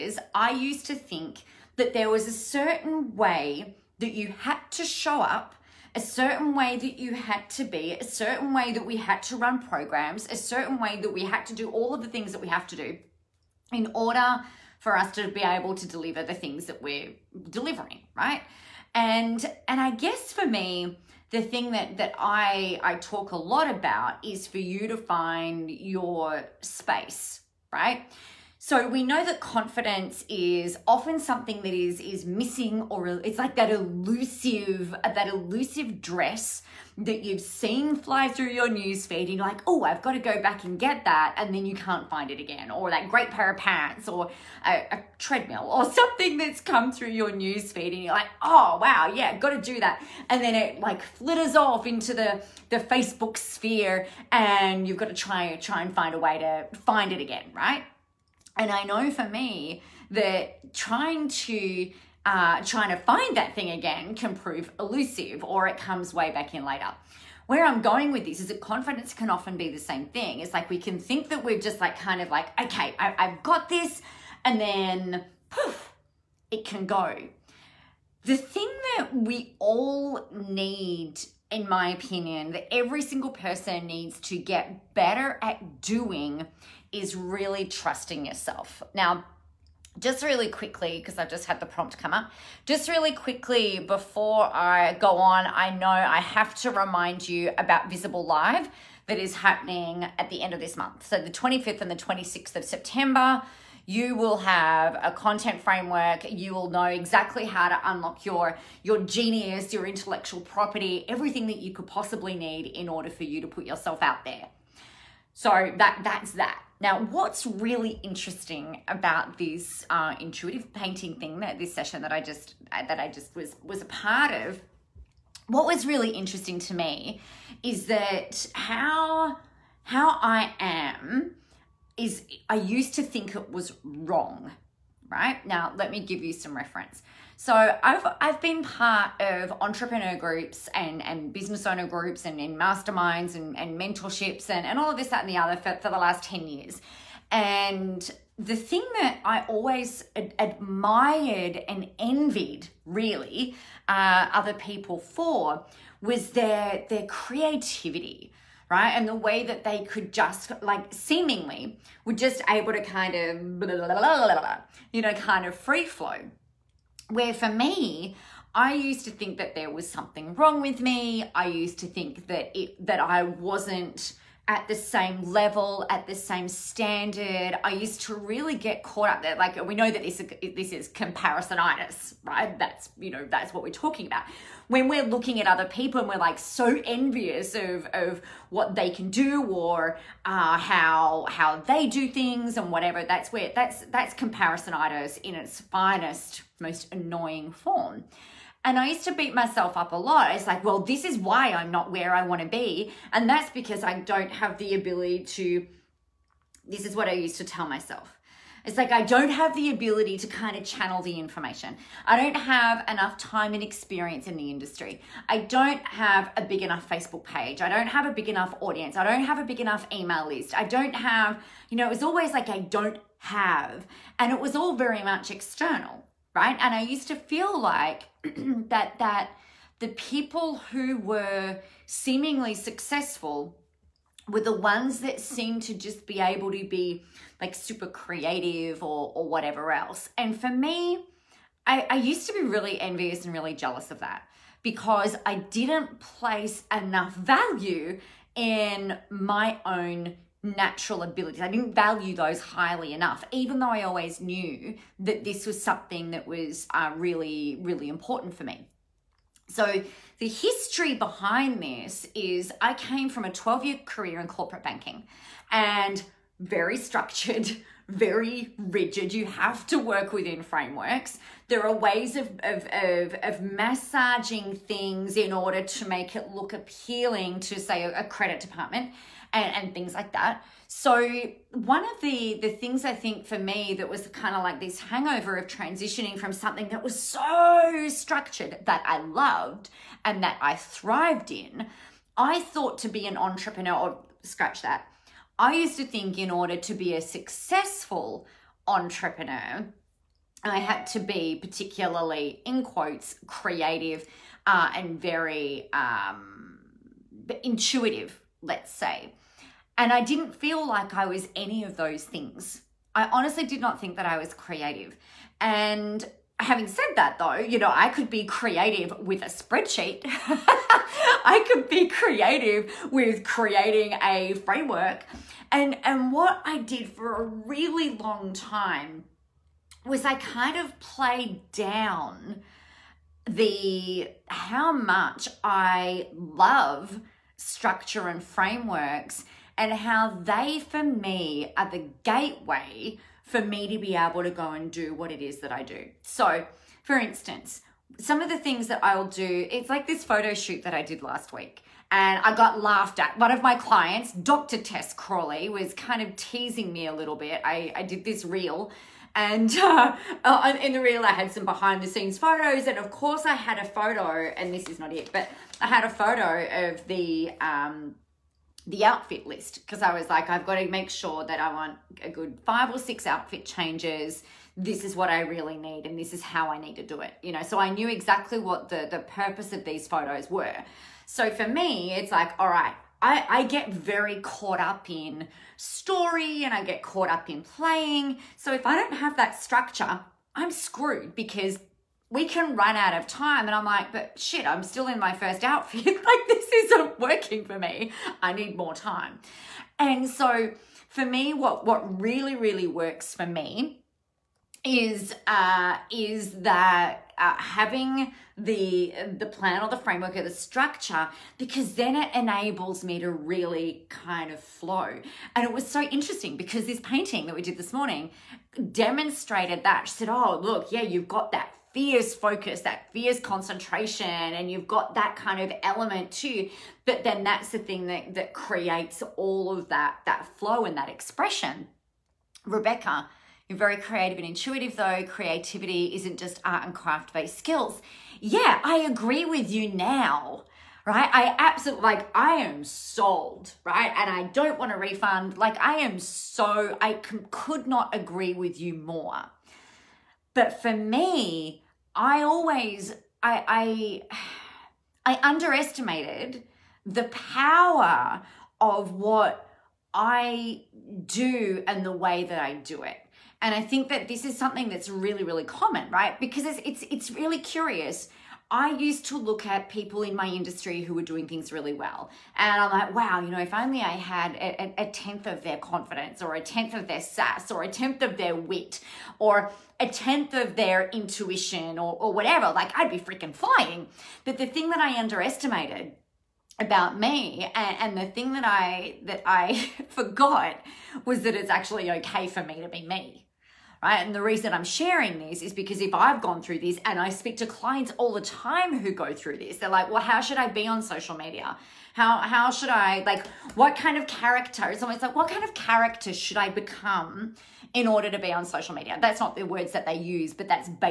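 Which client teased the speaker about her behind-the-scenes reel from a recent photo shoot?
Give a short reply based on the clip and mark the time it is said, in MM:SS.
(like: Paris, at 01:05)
Dr. Tess Crawley, at 05:54.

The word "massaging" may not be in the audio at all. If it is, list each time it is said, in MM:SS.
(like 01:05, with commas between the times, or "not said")
04:33.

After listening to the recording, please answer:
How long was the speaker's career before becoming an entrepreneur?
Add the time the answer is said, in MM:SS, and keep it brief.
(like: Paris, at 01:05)
12 years, at 04:23.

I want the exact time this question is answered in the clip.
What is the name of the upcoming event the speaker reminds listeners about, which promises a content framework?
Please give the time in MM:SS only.
01:37.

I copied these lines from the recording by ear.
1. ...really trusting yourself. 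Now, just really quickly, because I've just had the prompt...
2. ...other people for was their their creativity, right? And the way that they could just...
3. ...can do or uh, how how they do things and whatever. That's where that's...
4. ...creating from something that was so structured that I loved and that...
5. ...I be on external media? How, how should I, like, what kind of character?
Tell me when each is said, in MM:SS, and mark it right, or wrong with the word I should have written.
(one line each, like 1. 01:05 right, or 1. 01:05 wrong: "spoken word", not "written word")
1. 01:27 right
2. 02:34 right
3. 03:08 right
4. 04:45 wrong: "transitioning", not "creating"
5. 08:20 wrong: "social", not "external".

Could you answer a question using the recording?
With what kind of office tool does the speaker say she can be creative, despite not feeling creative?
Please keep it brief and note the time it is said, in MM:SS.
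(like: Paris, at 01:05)
A spreadsheet, at 05:19.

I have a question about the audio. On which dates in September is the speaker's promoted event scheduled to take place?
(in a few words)
25th and 26th.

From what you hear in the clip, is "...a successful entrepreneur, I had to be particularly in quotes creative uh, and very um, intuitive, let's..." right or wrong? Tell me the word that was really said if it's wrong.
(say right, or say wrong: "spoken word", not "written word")
right.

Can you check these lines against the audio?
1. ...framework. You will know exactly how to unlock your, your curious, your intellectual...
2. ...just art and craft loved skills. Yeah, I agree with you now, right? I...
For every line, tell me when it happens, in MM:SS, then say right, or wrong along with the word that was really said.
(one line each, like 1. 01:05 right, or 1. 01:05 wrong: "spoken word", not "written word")
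1. 01:45 wrong: "genius", not "curious"
2. 07:16 wrong: "based", not "loved".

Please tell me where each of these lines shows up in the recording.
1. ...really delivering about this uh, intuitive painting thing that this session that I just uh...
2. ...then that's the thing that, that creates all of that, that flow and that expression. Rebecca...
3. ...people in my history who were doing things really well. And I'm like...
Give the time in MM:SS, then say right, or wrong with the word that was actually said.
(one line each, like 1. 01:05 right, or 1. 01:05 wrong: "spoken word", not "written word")
1. 01:57 wrong: "interesting", not "delivering"
2. 07:07 right
3. 07:49 wrong: "industry", not "history".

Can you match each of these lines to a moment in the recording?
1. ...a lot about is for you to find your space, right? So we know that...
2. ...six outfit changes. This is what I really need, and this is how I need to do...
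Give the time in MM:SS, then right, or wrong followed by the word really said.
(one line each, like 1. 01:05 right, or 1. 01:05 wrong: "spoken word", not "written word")
1. 00:23 right
2. 06:12 right.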